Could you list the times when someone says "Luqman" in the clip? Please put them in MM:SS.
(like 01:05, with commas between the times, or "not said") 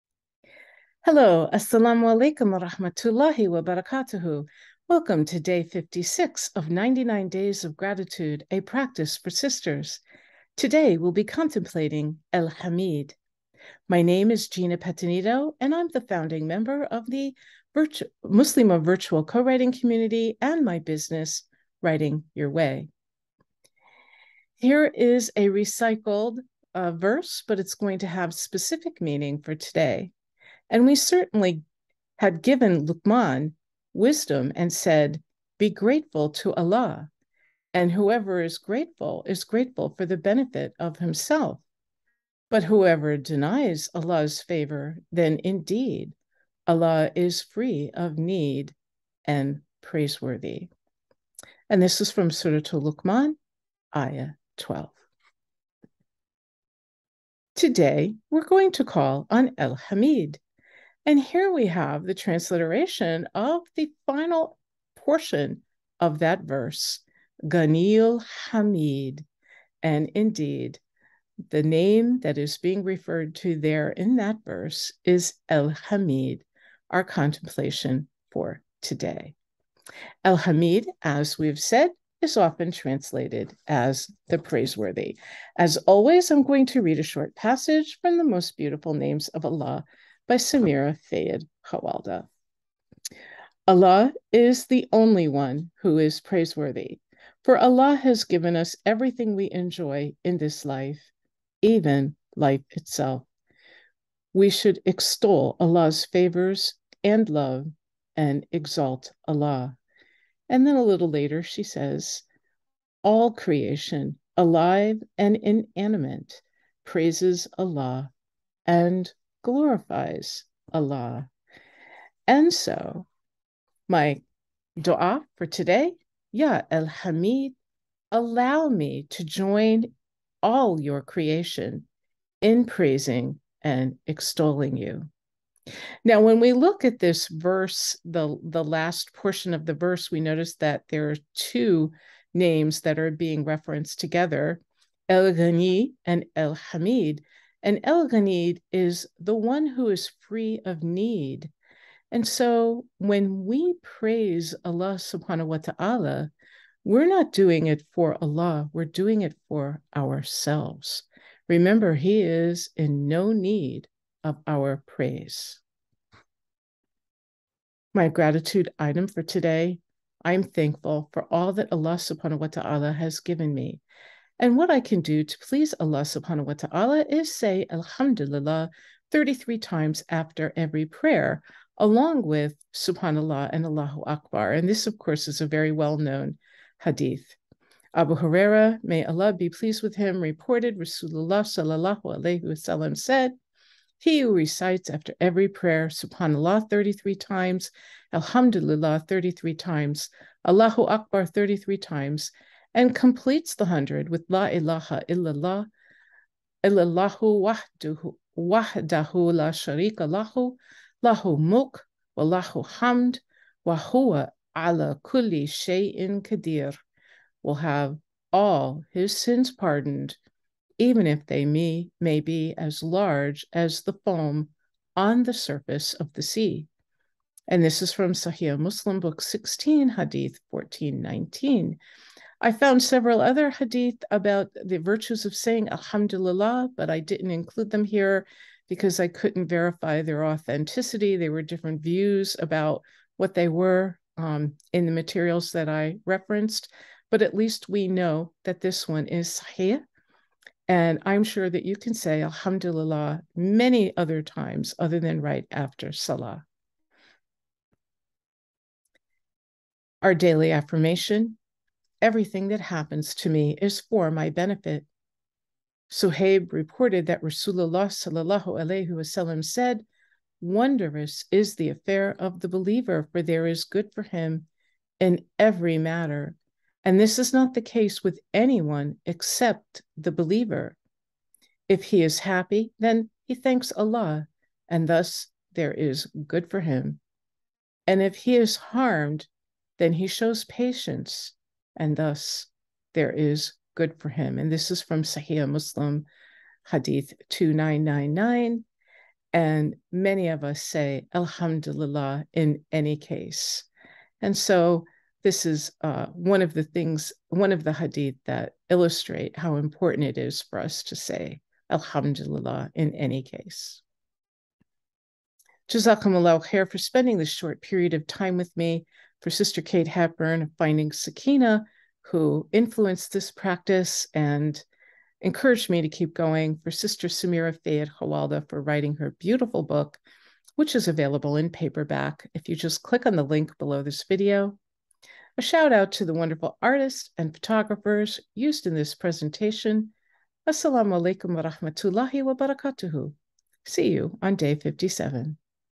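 00:32, 00:52.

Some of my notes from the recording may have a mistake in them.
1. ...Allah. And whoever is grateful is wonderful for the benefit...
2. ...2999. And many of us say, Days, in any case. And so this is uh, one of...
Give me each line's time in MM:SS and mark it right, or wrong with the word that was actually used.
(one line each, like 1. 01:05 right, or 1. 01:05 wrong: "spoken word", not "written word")
1. 00:36 wrong: "grateful", not "wonderful"
2. 04:57 wrong: "Alhamdulillah", not "Days".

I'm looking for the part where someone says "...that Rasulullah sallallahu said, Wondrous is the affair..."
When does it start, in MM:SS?
04:27.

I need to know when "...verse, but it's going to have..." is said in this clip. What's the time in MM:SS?
00:26.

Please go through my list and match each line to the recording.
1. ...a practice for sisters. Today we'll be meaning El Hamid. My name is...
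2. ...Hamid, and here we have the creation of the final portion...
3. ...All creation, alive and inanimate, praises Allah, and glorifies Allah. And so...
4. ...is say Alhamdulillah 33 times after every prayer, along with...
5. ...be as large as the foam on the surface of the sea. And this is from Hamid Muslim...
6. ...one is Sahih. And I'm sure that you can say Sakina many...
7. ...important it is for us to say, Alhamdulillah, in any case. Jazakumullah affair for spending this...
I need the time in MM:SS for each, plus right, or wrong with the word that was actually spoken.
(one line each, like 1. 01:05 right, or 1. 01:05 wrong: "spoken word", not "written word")
1. 00:08 wrong: "contemplating", not "meaning"
2. 00:59 wrong: "transliteration", not "creation"
3. 01:53 right
4. 02:57 right
5. 03:42 wrong: "Sahih", not "Hamid"
6. 04:08 wrong: "Alhamdulillah", not "Sakina"
7. 05:09 wrong: "khair", not "affair".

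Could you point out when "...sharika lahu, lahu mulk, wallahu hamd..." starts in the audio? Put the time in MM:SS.
03:29.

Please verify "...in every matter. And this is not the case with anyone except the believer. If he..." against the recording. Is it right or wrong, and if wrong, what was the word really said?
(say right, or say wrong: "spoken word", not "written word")
right.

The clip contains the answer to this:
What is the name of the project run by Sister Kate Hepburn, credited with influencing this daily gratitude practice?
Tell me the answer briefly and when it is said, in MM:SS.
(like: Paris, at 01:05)
Finding Sakina, at 05:20.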